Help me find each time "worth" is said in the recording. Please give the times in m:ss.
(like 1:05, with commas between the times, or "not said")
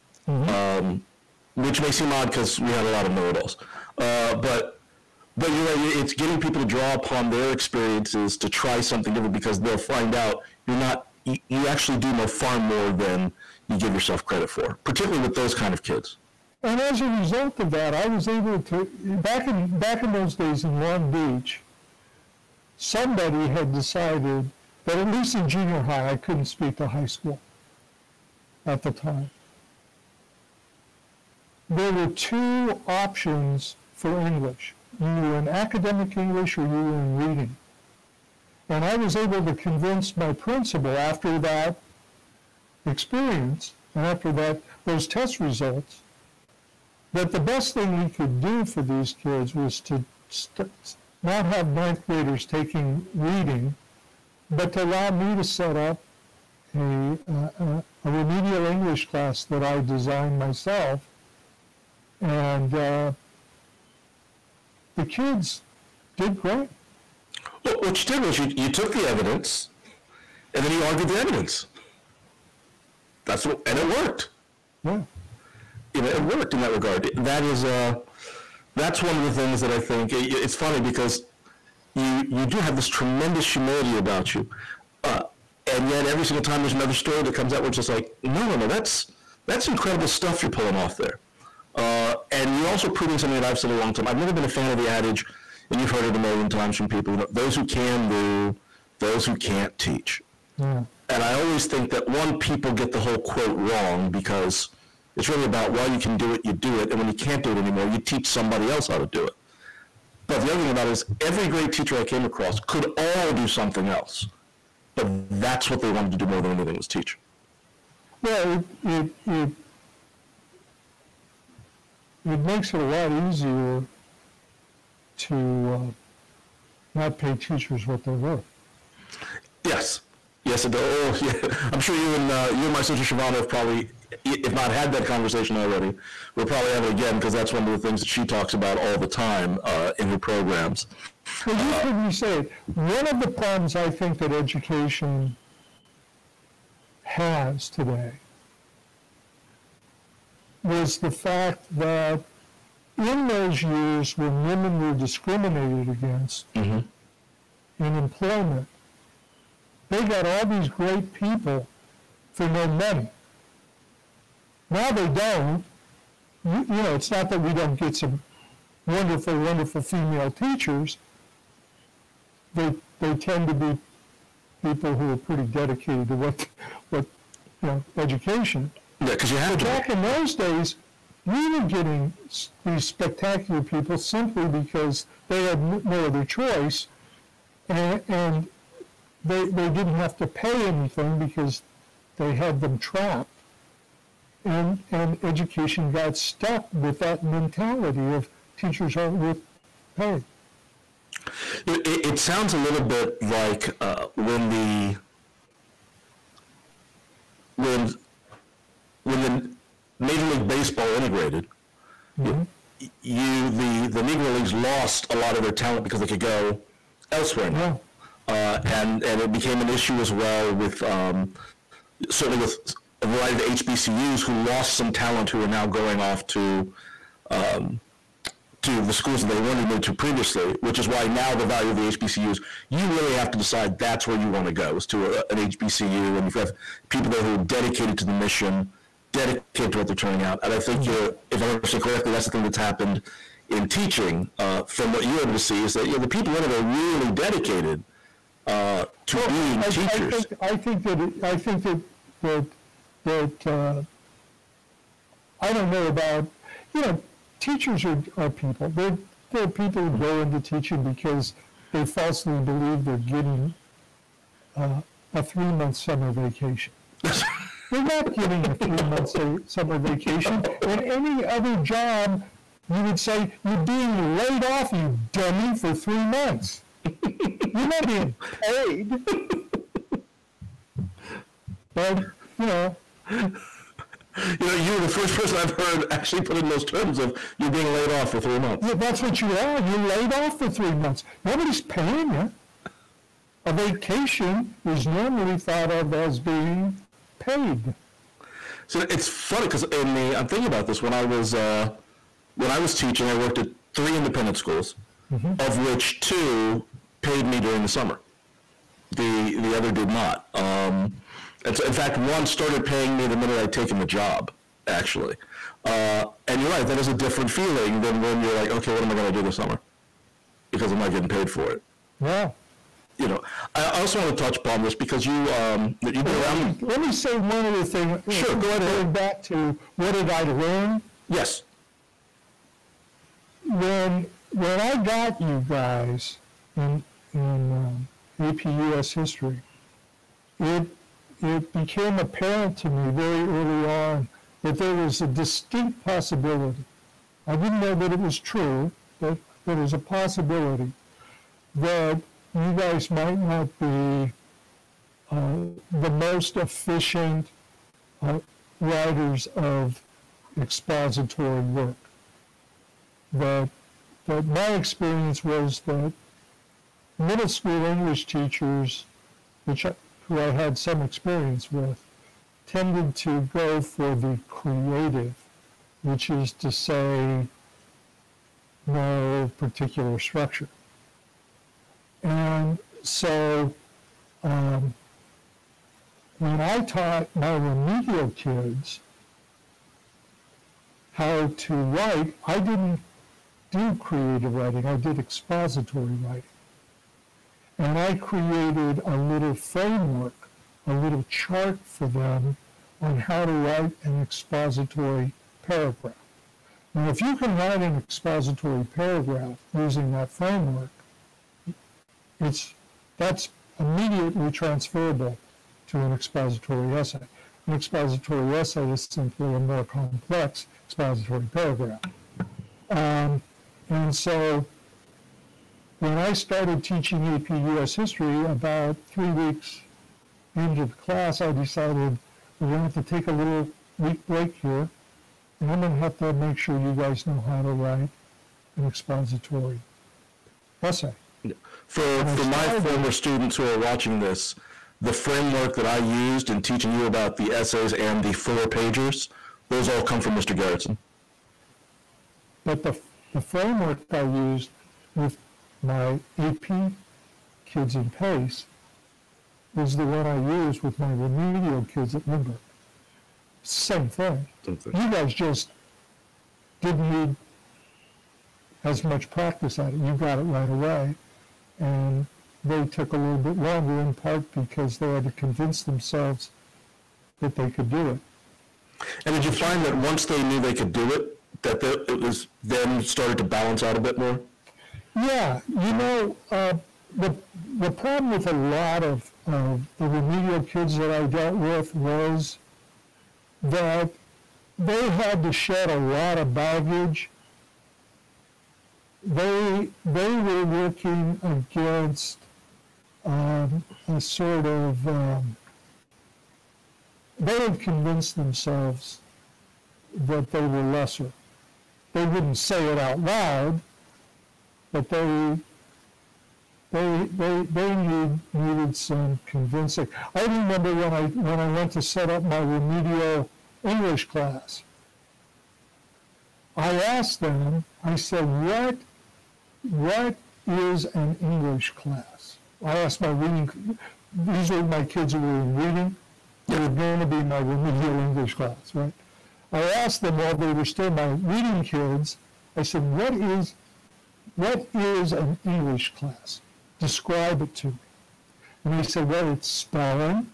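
2:08, 3:19.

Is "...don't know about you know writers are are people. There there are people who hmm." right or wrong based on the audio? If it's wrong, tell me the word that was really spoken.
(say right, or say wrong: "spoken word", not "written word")
wrong: "teachers", not "writers".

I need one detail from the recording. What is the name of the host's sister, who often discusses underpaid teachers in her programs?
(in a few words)
Shivana.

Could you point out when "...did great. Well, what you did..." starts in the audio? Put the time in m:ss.
1:06.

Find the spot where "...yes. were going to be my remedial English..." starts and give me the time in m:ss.
8:56.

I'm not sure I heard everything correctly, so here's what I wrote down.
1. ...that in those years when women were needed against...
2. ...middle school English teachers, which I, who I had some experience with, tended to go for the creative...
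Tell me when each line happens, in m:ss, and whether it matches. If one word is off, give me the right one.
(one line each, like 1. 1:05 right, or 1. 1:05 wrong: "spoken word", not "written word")
1. 2:31 wrong: "discriminated", not "needed"
2. 6:06 right.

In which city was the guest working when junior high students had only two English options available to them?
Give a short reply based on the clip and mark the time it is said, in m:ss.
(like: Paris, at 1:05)
Long Beach, at 0:20.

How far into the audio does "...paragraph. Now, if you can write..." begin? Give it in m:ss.
6:45.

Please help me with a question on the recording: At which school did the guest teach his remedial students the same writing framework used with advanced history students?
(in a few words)
Lindbergh.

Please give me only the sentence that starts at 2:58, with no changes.
Yeah, because you have but to.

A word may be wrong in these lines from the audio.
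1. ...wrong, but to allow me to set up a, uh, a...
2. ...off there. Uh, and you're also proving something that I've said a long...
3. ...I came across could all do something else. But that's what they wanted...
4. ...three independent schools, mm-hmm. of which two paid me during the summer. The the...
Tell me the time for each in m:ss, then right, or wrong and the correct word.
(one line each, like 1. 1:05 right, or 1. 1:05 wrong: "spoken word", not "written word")
1. 0:53 wrong: "reading", not "wrong"
2. 1:30 right
3. 1:51 right
4. 5:03 right.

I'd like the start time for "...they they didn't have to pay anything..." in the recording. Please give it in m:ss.
3:09.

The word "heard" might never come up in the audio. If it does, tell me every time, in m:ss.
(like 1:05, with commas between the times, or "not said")
1:35, 2:21, 4:45.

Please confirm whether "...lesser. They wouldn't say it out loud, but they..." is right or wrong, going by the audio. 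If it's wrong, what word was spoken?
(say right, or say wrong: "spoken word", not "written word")
right.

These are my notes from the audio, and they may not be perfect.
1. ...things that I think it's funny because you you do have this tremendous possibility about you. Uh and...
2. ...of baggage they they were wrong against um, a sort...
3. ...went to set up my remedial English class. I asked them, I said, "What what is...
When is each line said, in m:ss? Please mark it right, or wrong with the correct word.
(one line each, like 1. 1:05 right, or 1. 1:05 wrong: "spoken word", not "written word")
1. 1:19 wrong: "humility", not "possibility"
2. 8:16 wrong: "working", not "wrong"
3. 8:41 right.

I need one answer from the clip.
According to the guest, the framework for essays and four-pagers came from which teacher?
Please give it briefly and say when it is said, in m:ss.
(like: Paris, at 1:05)
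Mr. Garretson, at 7:30.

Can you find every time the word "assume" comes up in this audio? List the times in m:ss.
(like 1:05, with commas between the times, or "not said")
not said.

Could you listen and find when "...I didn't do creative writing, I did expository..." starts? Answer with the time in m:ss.
6:32.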